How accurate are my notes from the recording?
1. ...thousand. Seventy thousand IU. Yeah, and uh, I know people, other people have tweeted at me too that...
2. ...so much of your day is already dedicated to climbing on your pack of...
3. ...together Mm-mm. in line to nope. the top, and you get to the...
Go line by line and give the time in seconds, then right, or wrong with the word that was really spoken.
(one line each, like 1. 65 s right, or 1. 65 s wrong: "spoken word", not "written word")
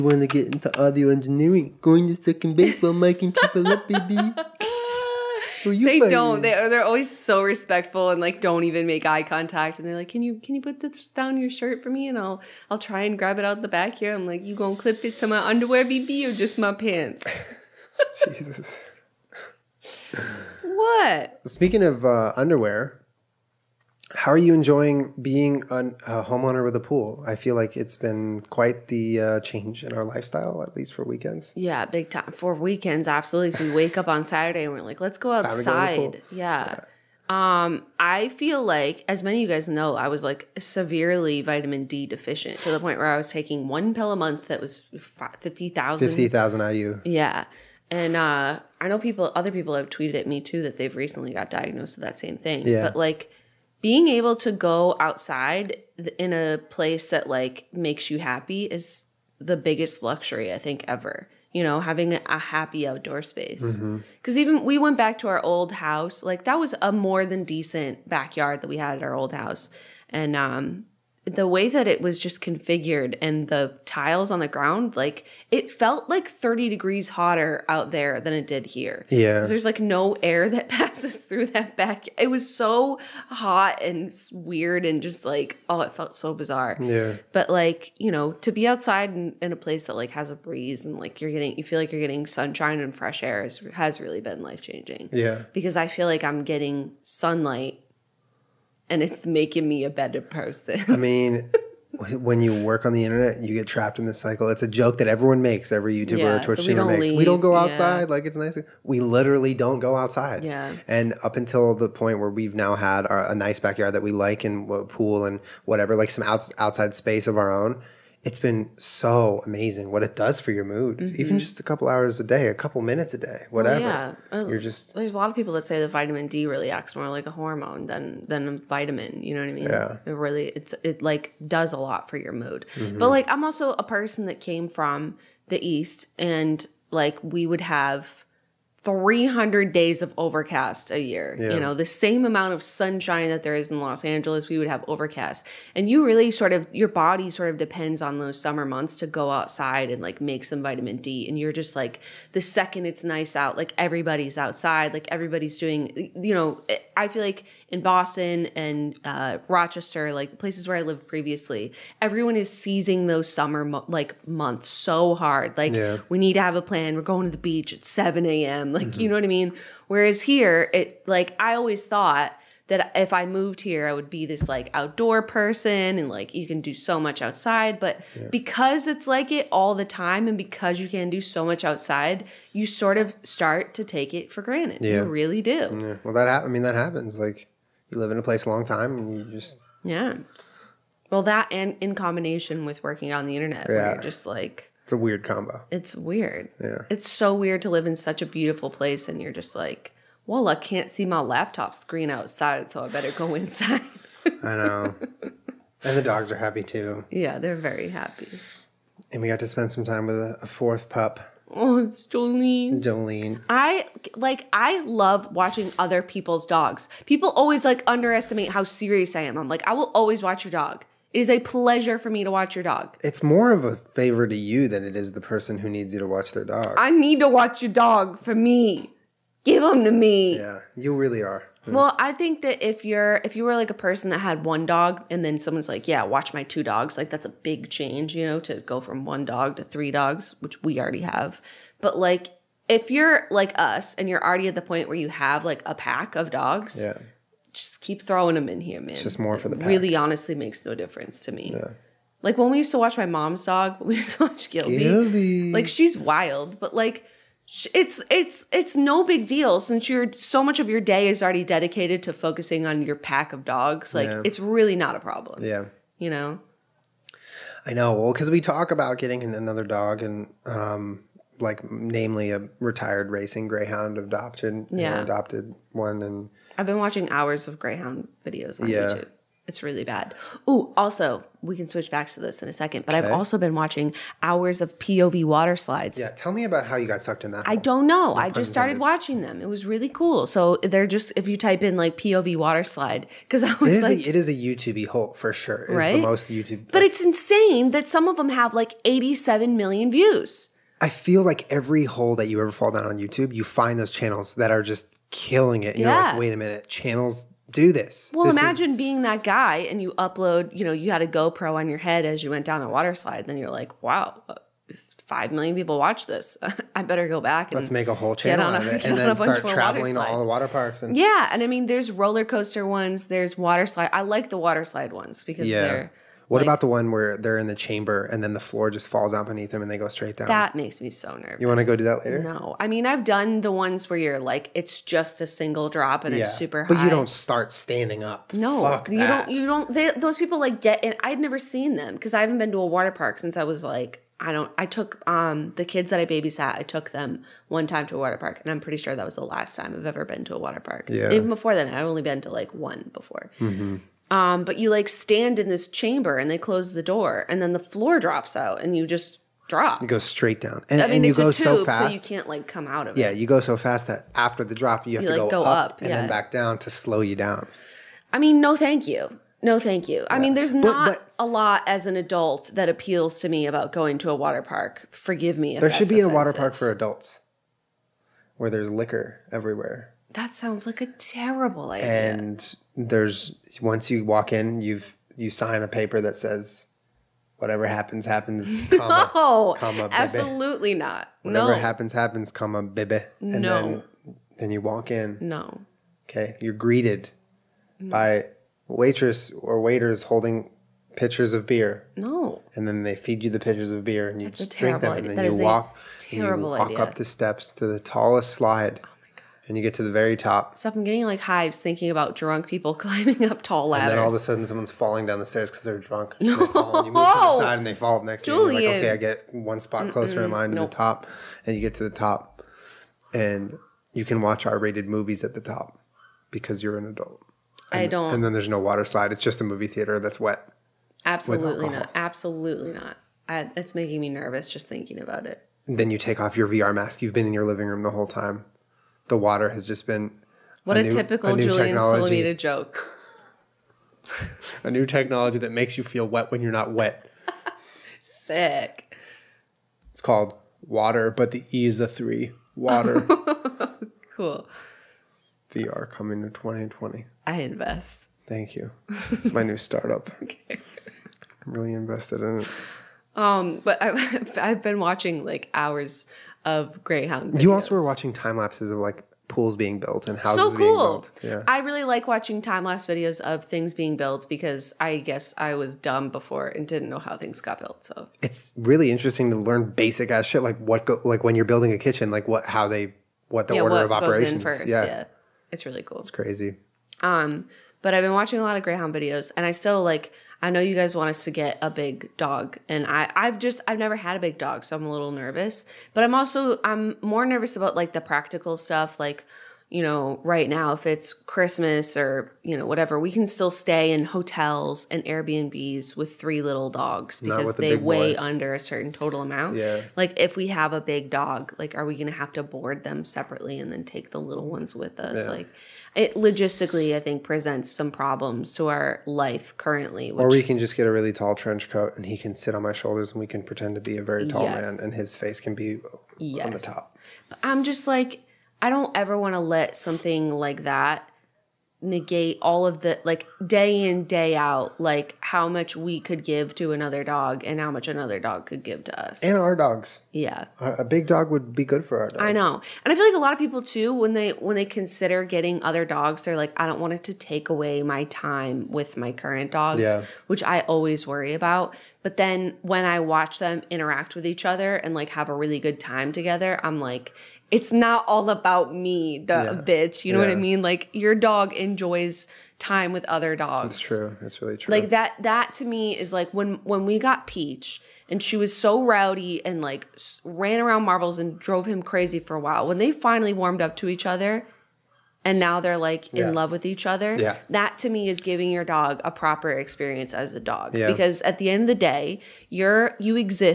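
1. 45 s wrong: "Fifty", not "Seventy"
2. 260 s wrong: "focusing", not "climbing"
3. 419 s wrong: "closer", not "together".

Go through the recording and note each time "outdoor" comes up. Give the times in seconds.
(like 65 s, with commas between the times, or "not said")
62 s, 174 s.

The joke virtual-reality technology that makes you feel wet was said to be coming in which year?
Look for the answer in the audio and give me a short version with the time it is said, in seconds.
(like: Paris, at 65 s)
2020, at 456 s.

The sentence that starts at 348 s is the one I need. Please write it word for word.
And I'm pretty sure that was the last time I've ever been to a water park.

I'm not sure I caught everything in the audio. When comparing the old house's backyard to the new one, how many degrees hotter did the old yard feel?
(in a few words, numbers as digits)
30.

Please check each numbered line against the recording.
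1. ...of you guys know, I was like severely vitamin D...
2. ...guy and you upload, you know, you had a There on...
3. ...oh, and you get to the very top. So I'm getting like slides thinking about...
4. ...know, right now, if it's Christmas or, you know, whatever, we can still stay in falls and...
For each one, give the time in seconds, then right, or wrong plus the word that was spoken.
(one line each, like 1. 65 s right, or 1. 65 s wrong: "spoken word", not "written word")
1. 39 s right
2. 309 s wrong: "GoPro", not "There"
3. 408 s wrong: "hives", not "slides"
4. 499 s wrong: "hotels", not "falls".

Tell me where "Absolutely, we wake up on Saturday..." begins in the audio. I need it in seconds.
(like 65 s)
33 s.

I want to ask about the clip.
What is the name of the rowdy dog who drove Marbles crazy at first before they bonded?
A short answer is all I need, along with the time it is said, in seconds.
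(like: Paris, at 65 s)
Peach, at 567 s.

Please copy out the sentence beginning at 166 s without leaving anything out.
We're going to the beach at 7 a.m like, mm-hmm.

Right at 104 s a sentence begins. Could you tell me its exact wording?
It's a joke that everyone makes, every YouTuber yeah, or Twitch streamer makes.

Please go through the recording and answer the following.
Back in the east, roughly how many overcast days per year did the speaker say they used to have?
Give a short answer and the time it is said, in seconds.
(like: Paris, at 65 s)
300, at 138 s.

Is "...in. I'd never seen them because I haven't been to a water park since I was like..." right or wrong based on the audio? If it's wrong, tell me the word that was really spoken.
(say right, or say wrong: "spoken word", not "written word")
right.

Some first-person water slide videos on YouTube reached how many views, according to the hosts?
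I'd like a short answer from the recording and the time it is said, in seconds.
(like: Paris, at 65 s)
87 million, at 298 s.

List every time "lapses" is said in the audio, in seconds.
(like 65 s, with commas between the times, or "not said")
468 s, 472 s.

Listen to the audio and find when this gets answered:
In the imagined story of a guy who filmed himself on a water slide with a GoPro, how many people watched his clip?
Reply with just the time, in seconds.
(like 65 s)
315 s.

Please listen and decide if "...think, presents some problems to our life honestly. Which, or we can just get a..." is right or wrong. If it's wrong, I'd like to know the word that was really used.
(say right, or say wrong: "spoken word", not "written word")
wrong: "currently", not "honestly".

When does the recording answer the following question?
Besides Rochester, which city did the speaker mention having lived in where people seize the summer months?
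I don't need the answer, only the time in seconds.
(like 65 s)
157 s.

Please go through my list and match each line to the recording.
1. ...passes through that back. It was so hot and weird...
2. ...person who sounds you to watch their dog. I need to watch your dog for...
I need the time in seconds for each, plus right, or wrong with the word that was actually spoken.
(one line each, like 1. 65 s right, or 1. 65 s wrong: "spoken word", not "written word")
1. 80 s right
2. 225 s wrong: "needs", not "sounds".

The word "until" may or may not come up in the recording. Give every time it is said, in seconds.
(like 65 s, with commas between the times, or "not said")
111 s.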